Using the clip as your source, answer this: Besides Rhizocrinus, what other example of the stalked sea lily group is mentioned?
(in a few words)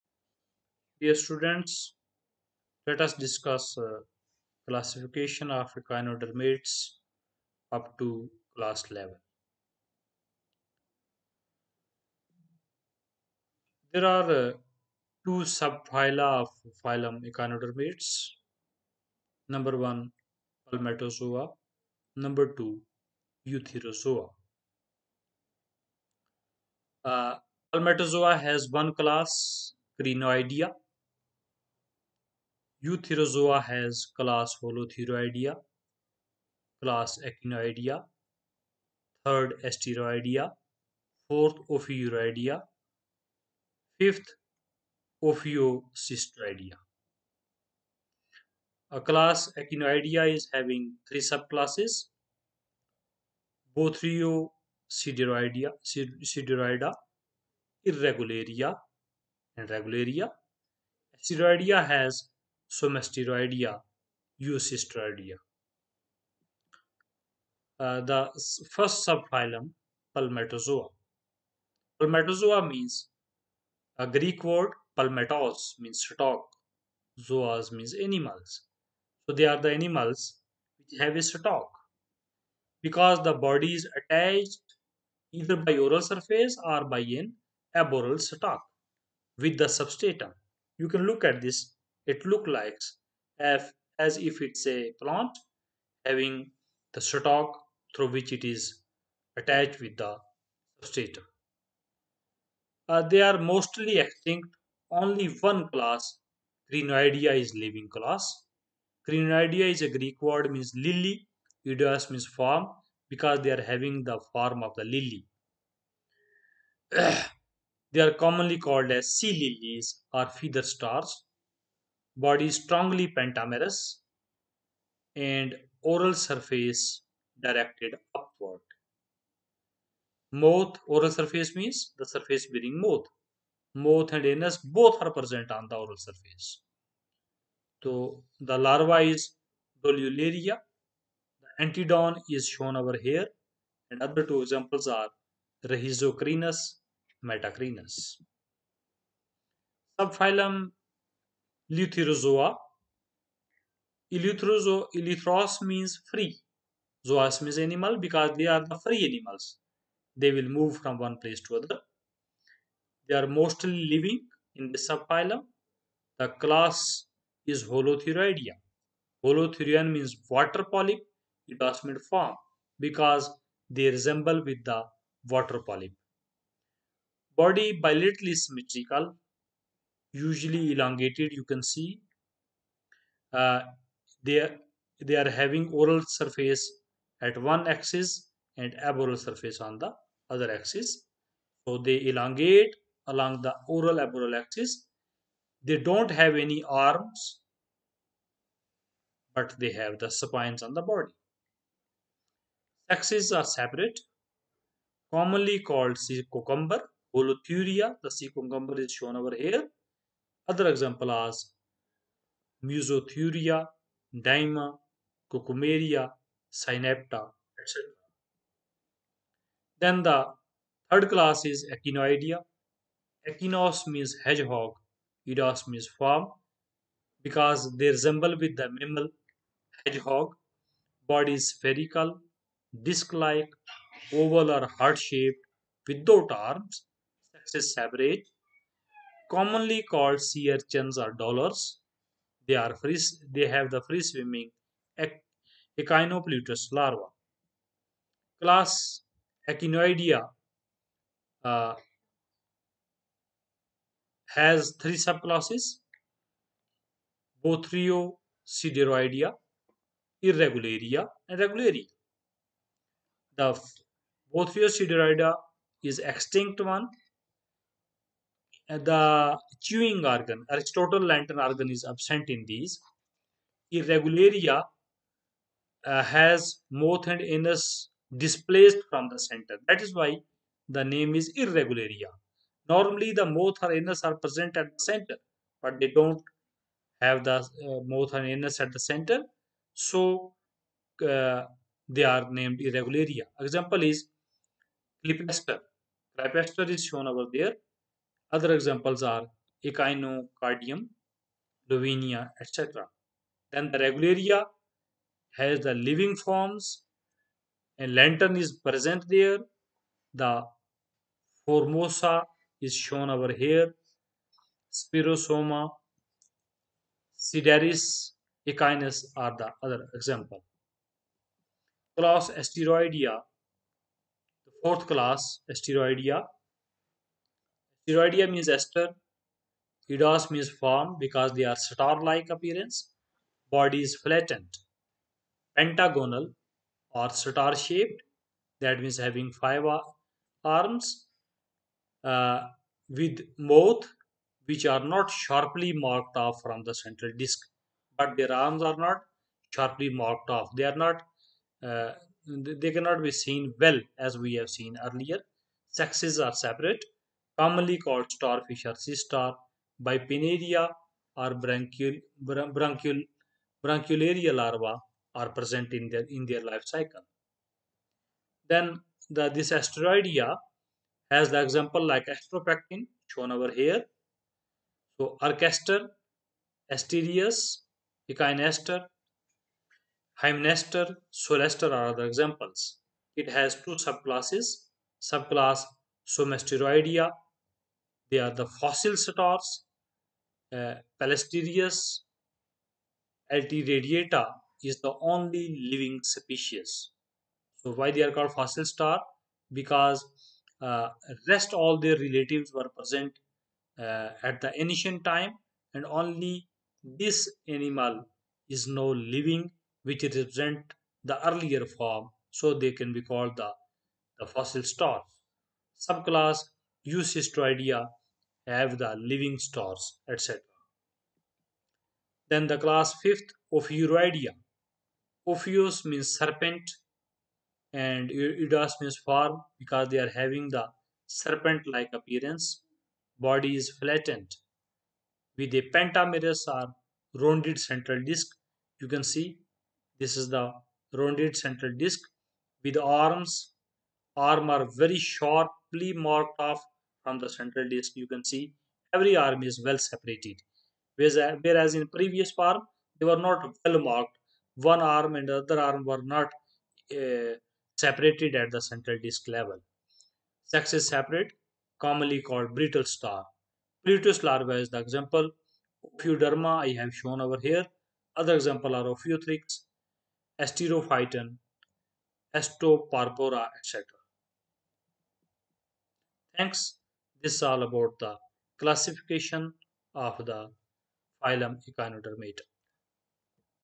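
Metacrinus.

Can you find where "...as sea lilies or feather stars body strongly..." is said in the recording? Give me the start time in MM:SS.
01:58.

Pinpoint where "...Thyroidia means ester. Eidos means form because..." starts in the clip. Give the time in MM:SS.
05:27.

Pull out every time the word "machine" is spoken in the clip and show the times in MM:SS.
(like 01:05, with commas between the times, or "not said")
not said.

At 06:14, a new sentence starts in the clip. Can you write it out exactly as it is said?
So arcaster, Asterias, echinaster, hymnaster, Solaster are other examples.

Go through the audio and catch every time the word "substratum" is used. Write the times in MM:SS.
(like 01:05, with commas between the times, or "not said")
01:29, 01:40.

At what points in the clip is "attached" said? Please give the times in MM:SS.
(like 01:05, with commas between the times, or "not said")
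01:23, 01:39.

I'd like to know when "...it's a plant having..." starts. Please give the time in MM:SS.
01:34.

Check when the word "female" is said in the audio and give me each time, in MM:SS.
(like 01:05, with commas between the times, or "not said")
not said.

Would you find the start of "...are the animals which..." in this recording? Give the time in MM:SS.
01:19.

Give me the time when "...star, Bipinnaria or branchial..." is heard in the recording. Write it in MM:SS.
05:58.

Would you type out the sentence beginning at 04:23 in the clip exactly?
The Bothrio sideroidea is extinct one the chewing organ, Aristotle lantern organ is absent in these.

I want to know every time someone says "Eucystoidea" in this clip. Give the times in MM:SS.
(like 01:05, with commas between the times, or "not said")
06:56.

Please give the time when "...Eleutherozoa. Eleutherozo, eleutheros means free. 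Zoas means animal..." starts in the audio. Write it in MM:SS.
02:31.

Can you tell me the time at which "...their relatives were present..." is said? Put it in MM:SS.
06:41.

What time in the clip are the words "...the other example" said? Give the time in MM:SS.
05:19.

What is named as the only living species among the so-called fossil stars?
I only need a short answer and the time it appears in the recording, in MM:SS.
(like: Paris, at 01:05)
Platasterias altiradiata, at 06:30.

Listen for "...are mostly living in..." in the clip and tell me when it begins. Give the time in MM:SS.
02:43.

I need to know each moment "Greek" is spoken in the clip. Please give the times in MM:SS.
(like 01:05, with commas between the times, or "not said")
01:14, 01:49.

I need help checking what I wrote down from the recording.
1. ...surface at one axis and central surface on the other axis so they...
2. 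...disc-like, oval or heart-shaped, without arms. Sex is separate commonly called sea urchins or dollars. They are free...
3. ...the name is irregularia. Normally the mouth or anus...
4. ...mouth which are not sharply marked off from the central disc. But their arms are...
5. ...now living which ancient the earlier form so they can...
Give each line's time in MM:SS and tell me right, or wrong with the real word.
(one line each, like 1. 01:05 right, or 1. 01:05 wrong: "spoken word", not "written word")
1. 03:06 wrong: "aboral", not "central"
2. 03:52 right
3. 04:40 right
4. 05:43 right
5. 06:48 wrong: "represent", not "ancient".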